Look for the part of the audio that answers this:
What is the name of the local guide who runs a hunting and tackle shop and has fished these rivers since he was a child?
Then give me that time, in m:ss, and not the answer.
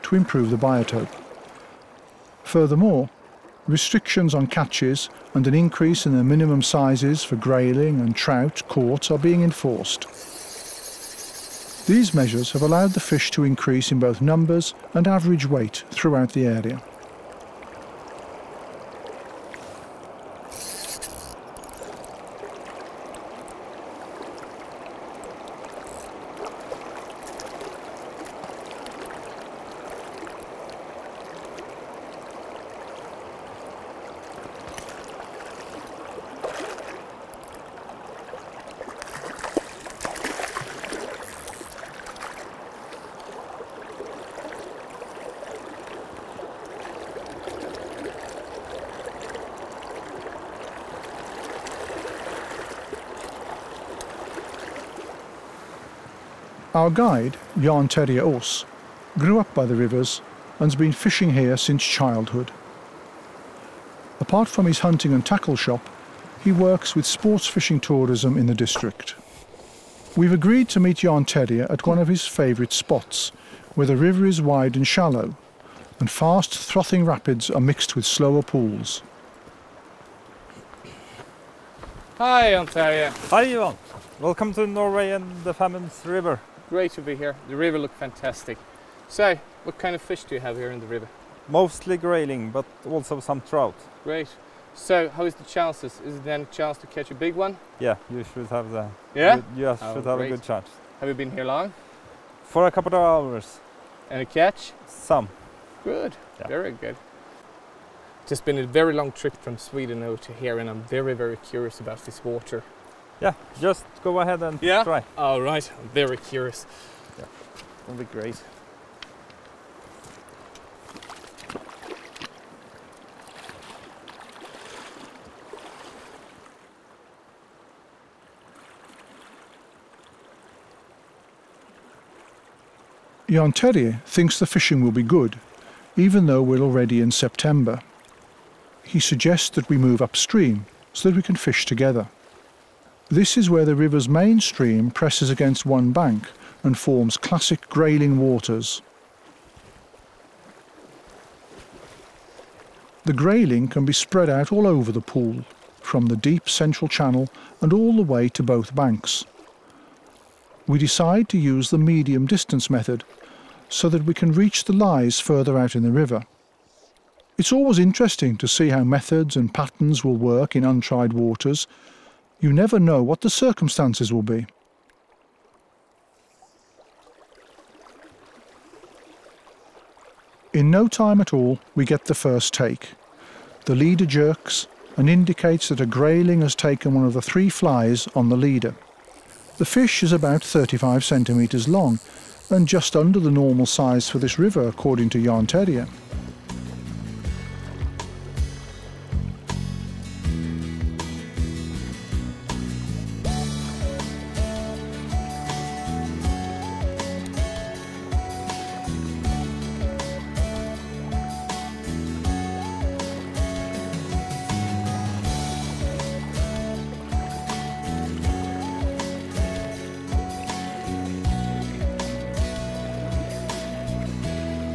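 0:57.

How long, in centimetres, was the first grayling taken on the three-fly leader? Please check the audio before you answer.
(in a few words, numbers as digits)
35 centimetres.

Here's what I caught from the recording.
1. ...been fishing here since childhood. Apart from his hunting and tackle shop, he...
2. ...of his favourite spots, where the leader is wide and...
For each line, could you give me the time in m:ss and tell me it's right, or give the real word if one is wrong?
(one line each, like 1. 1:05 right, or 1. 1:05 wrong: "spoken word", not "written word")
1. 1:00 right
2. 1:11 wrong: "river", not "leader".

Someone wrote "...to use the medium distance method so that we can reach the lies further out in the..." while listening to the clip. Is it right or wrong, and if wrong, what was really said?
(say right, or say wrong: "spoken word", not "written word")
right.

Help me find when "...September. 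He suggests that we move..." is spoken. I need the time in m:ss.
2:17.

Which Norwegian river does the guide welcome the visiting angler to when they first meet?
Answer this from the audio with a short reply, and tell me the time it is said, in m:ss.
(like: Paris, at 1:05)
Femund River, at 1:25.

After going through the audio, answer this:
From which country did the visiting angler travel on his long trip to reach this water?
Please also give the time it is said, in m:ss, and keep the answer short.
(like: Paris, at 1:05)
Sweden, at 1:49.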